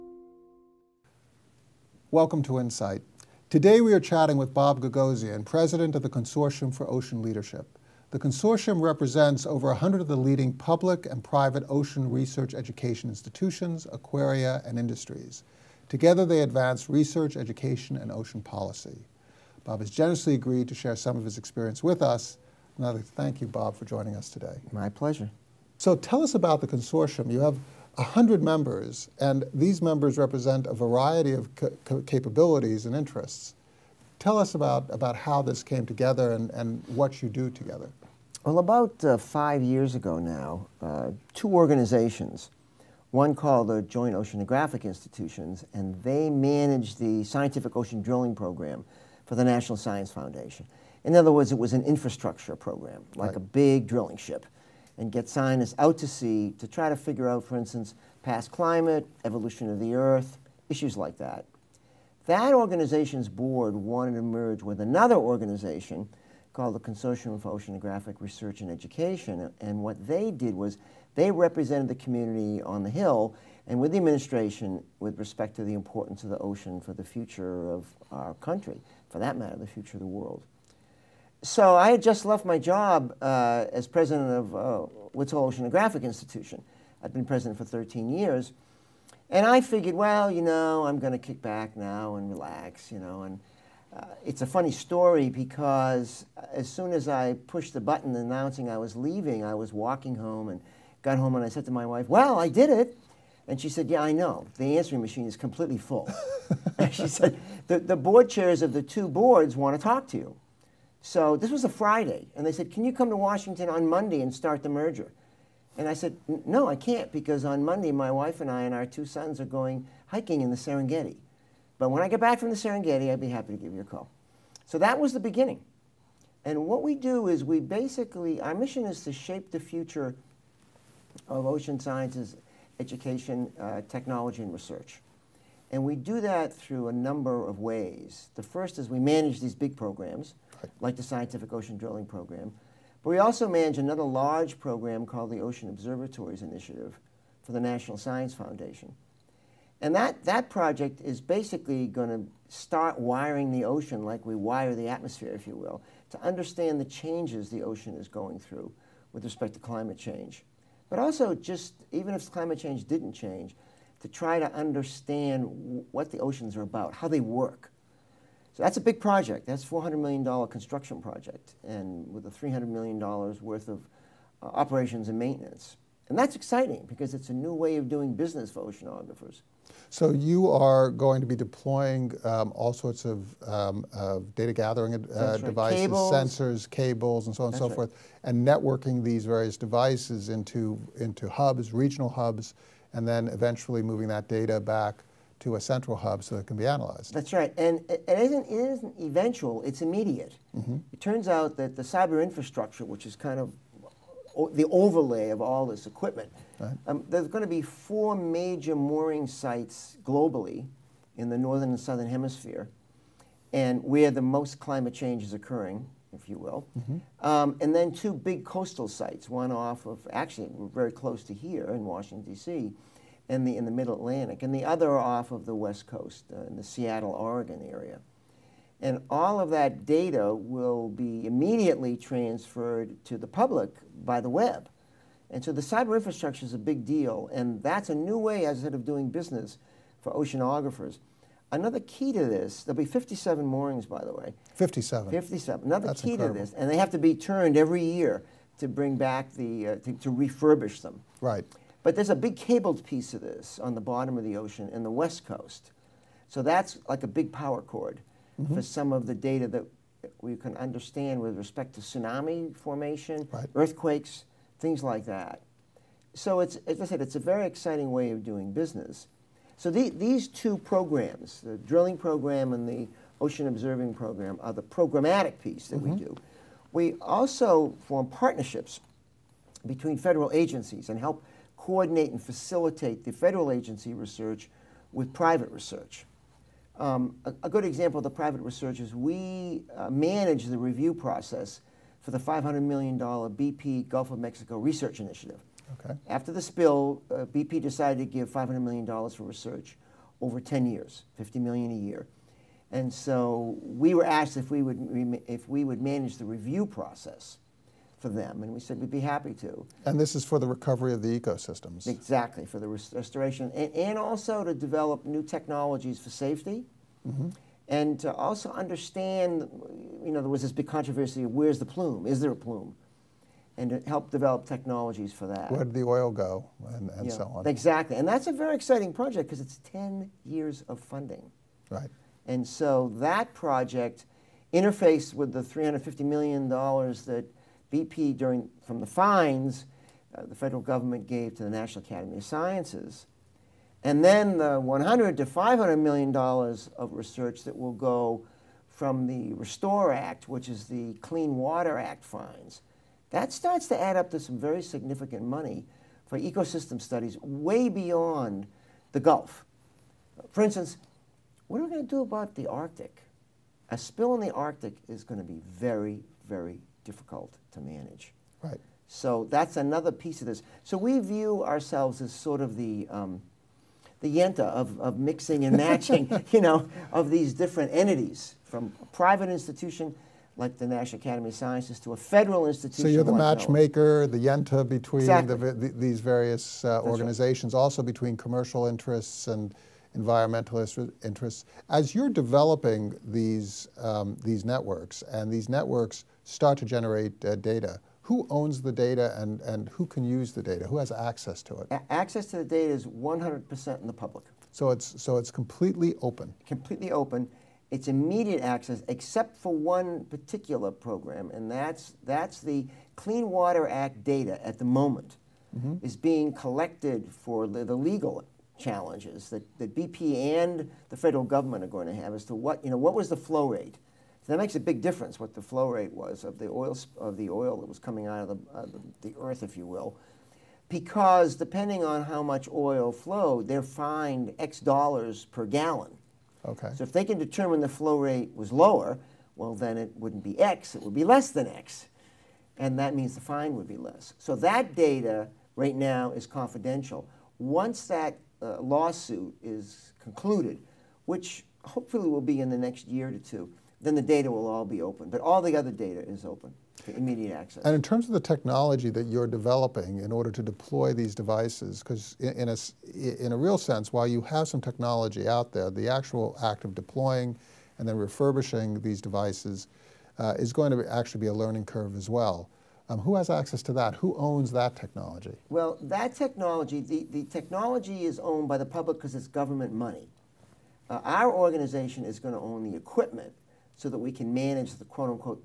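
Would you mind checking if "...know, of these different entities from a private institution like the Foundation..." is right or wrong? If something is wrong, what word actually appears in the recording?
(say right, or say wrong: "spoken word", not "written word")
wrong: "National", not "Foundation".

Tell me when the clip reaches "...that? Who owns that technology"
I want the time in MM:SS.
07:53.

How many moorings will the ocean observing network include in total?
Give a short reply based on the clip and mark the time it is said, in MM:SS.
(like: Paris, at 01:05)
57, at 04:02.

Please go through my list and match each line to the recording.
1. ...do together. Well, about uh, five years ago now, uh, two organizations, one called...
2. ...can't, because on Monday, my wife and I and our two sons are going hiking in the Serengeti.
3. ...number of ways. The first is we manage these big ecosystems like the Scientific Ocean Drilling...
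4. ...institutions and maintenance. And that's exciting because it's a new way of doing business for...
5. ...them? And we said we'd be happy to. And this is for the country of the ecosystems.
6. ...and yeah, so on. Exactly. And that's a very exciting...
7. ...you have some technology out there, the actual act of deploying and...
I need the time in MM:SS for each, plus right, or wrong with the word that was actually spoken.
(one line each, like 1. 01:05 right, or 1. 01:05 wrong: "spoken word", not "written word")
1. 00:37 right
2. 01:56 right
3. 02:16 wrong: "programs", not "ecosystems"
4. 02:54 wrong: "operations", not "institutions"
5. 05:08 wrong: "recovery", not "country"
6. 05:26 right
7. 07:44 right.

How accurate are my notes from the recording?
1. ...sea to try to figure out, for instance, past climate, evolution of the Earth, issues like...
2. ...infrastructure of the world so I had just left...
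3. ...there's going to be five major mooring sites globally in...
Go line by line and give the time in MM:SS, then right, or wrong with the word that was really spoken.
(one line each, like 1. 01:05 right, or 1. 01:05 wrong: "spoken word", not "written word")
1. 00:56 right
2. 01:19 wrong: "future", not "infrastructure"
3. 03:27 wrong: "four", not "five".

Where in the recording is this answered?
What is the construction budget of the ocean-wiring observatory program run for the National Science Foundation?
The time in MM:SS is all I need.
02:49.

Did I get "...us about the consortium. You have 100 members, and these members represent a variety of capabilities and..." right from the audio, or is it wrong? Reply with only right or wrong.
right.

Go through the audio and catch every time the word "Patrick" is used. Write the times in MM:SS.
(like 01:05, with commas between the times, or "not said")
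not said.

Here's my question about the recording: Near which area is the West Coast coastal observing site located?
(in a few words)
Seattle, Oregon area.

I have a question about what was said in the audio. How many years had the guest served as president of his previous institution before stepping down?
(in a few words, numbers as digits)
13.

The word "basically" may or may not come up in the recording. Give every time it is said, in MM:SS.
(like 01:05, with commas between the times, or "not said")
02:07, 02:31.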